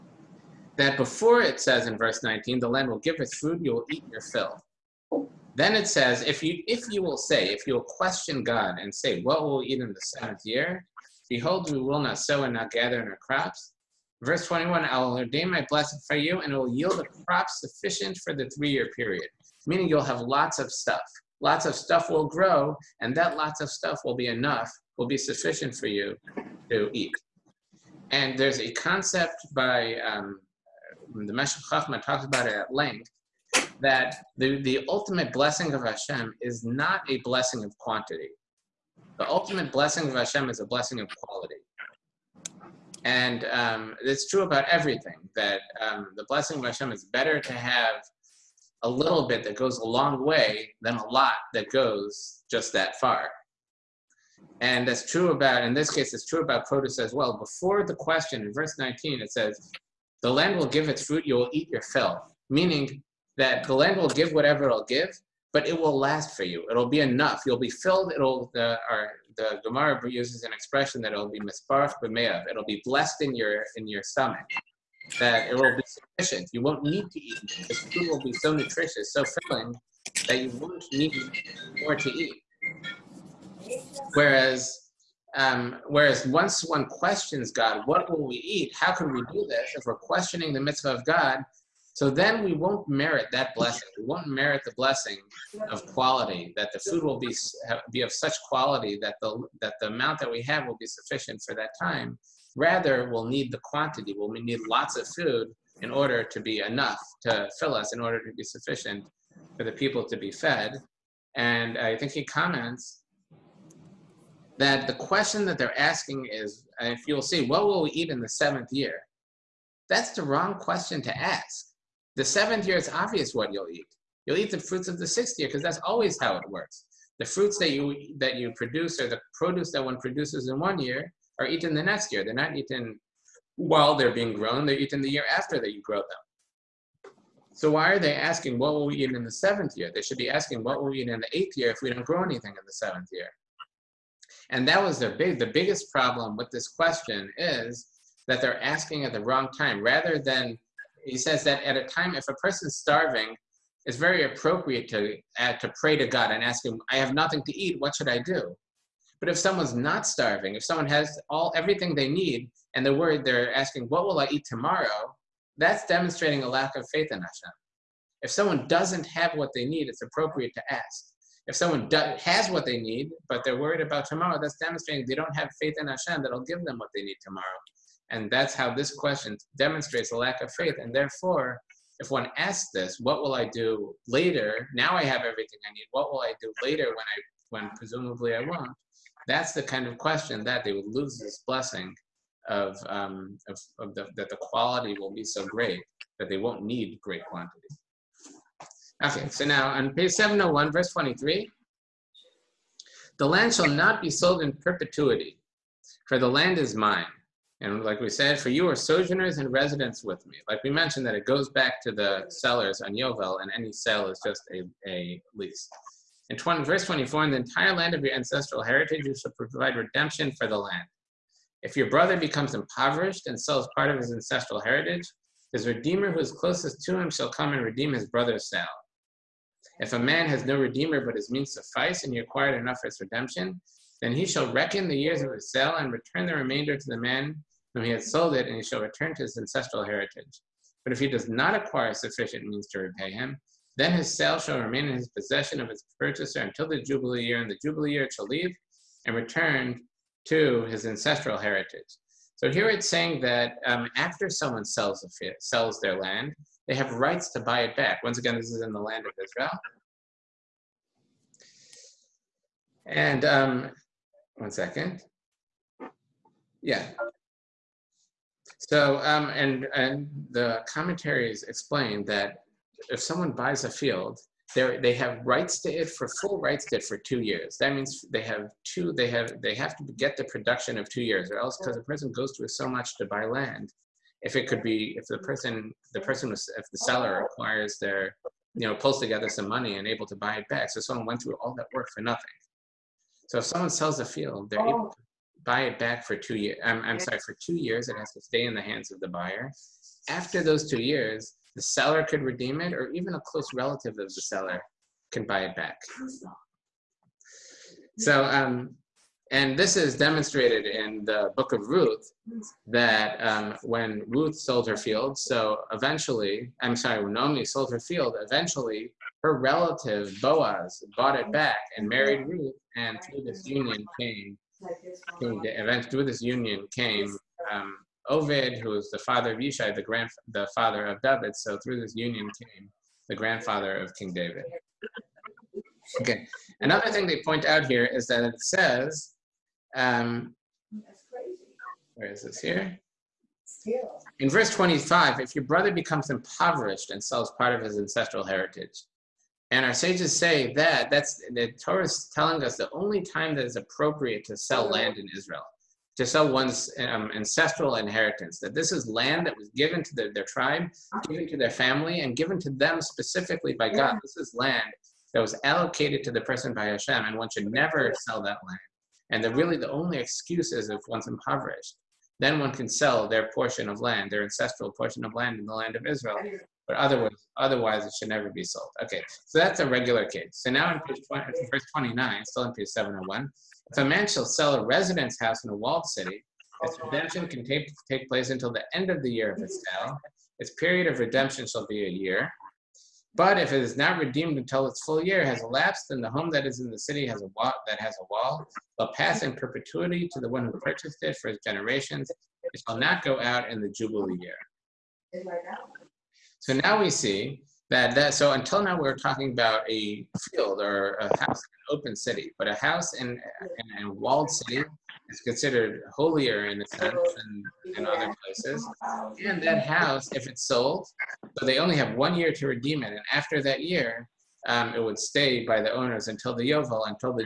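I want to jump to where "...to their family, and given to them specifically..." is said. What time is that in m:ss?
6:01.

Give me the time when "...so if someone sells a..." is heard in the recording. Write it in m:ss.
4:53.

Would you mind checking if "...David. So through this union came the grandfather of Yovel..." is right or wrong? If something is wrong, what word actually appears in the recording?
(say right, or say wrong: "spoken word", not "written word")
wrong: "King", not "Yovel".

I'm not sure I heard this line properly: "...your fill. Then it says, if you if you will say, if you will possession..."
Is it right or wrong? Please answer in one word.
wrong.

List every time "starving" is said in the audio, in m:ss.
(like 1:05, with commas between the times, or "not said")
2:32, 2:40.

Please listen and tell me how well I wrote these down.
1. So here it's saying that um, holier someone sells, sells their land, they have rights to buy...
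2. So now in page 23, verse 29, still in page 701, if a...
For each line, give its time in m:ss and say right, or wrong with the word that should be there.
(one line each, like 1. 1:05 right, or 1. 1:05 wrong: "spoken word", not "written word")
1. 4:12 wrong: "after", not "holier"
2. 6:20 wrong: "20", not "23".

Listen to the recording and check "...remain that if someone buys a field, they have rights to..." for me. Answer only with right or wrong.
wrong.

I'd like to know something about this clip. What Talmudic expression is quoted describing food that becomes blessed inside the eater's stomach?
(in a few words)
misbarech b'meyav.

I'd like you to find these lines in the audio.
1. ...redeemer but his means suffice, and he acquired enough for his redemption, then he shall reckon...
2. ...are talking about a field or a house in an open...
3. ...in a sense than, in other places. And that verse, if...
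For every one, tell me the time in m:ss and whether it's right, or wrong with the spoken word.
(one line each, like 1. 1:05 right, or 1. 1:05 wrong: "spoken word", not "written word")
1. 3:50 right
2. 6:48 right
3. 6:56 wrong: "house", not "verse".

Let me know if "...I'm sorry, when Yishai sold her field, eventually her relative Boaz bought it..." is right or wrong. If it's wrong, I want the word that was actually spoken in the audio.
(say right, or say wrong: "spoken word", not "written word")
wrong: "Naomi", not "Yishai".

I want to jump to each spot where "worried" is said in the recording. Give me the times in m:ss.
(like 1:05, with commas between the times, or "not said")
2:42, 2:53.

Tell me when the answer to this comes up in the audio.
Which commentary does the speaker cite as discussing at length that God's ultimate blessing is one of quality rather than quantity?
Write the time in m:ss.
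0:31.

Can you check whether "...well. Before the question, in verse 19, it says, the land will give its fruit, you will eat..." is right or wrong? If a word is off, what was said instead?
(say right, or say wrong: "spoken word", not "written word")
right.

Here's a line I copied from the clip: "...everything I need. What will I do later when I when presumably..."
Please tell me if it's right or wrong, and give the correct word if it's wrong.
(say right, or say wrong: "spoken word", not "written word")
right.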